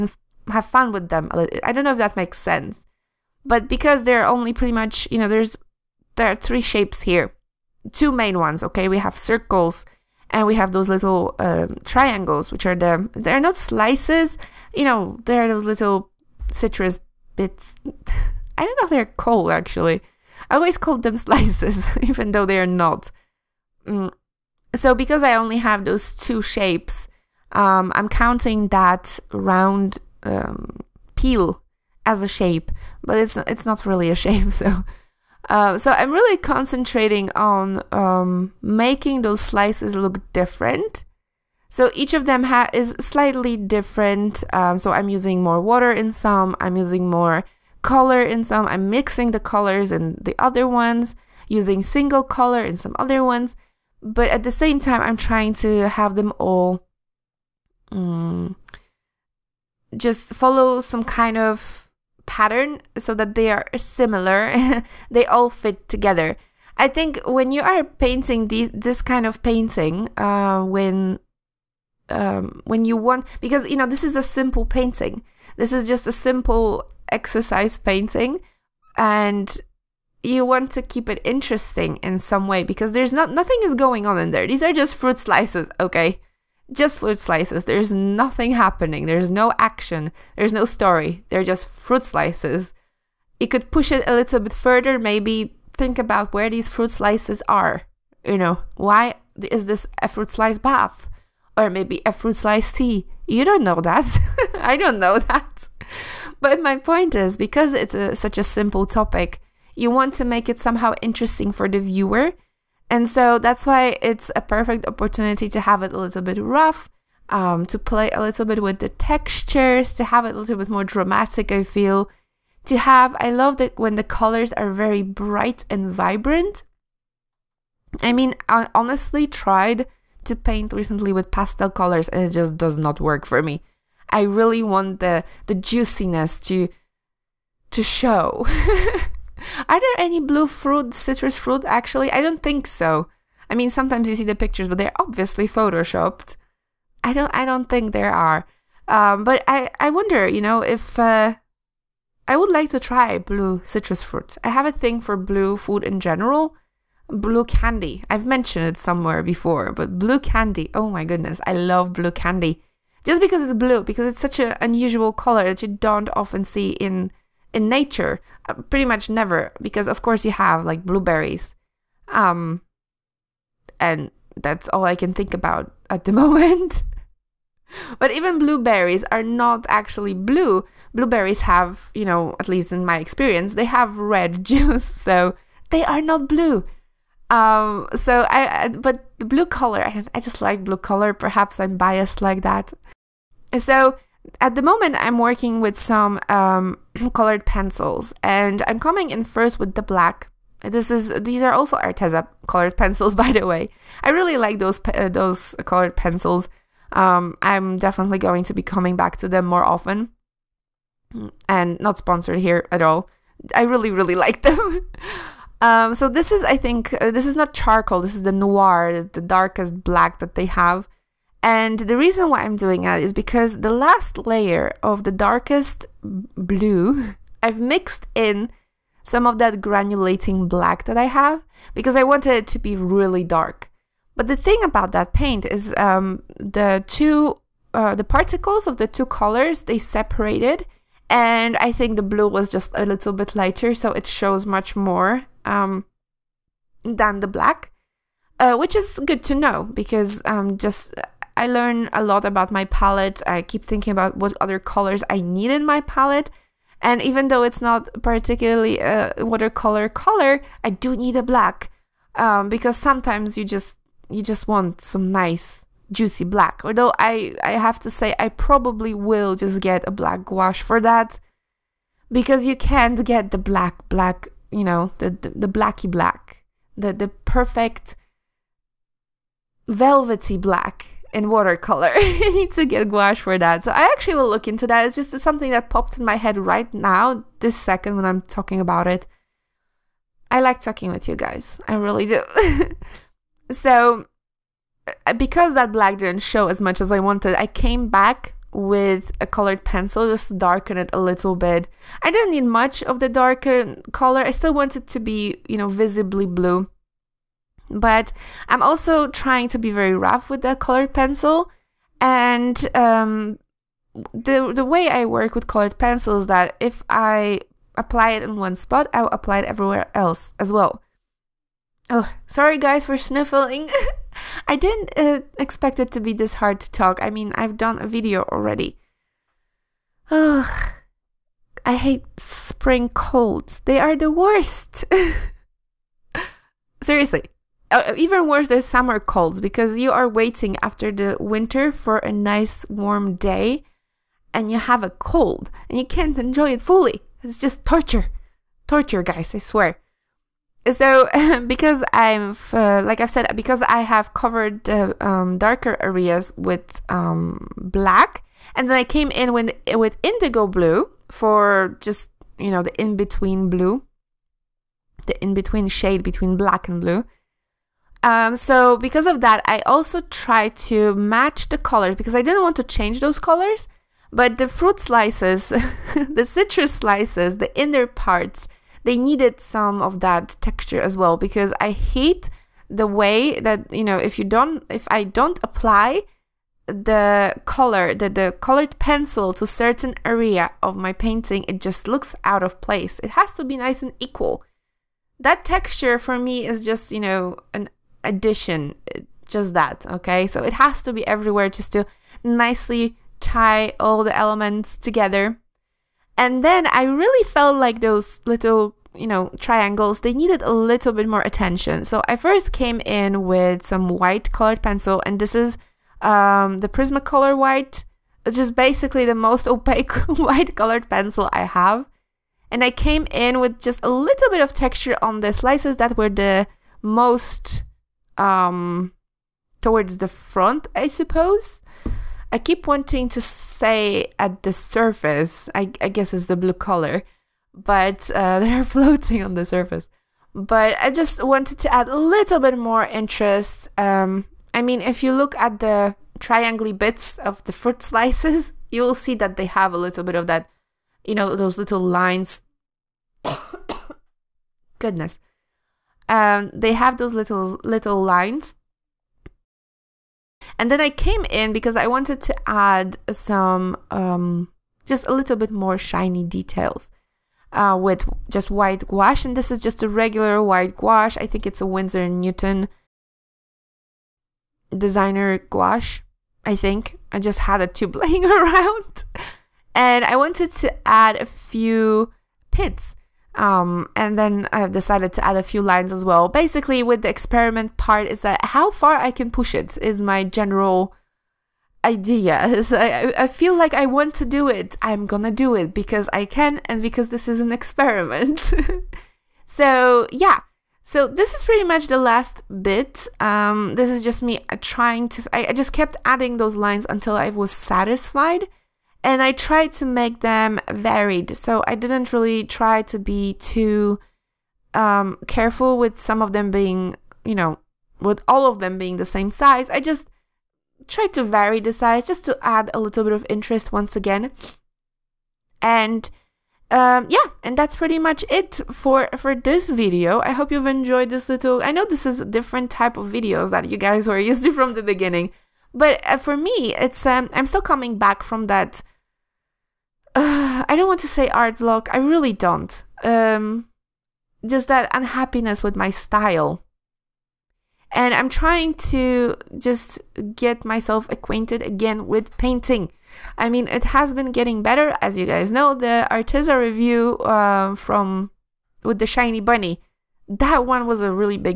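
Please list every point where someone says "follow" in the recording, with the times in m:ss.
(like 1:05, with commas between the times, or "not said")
1:00.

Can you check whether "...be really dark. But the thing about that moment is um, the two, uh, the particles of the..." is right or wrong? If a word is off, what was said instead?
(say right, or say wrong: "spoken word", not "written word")
wrong: "paint", not "moment".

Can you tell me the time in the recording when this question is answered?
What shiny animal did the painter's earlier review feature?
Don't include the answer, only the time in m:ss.
9:19.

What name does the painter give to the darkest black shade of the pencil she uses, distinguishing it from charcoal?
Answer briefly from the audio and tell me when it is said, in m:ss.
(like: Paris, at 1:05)
Noir, at 3:38.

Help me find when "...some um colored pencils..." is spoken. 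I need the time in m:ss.
3:15.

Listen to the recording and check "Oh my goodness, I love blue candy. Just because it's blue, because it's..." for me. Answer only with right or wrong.
right.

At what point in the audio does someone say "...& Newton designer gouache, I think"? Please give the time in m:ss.
7:52.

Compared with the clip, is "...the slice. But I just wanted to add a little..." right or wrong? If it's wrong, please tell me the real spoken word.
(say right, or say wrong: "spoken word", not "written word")
wrong: "surface", not "slice".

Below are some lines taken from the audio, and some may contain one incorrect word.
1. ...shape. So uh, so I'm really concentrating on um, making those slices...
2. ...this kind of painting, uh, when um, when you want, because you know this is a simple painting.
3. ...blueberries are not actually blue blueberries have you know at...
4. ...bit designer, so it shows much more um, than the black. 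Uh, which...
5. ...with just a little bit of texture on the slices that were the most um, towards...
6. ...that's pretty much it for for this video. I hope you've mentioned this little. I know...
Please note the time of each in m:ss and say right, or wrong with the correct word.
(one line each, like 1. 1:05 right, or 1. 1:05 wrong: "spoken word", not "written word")
1. 0:34 right
2. 1:08 right
3. 2:58 right
4. 4:03 wrong: "lighter", not "designer"
5. 7:03 right
6. 8:47 wrong: "enjoyed", not "mentioned".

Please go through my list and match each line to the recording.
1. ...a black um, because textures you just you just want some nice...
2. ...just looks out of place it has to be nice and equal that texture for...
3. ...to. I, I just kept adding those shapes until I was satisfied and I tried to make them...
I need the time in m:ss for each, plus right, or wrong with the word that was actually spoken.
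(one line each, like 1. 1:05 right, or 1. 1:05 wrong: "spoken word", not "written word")
1. 4:21 wrong: "sometimes", not "textures"
2. 6:31 right
3. 8:25 wrong: "lines", not "shapes".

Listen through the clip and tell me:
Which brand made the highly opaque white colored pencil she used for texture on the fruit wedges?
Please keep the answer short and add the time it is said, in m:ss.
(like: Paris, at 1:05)
Prismacolor, at 6:56.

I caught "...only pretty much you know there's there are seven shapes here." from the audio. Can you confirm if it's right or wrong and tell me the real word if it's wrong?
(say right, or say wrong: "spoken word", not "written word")
wrong: "three", not "seven".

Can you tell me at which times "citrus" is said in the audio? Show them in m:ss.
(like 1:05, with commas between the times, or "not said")
0:16, 2:20, 2:33, 6:16.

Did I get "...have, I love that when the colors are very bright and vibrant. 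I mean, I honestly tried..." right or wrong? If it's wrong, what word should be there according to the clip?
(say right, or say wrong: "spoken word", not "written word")
right.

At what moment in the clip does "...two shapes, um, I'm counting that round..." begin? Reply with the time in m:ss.
0:26.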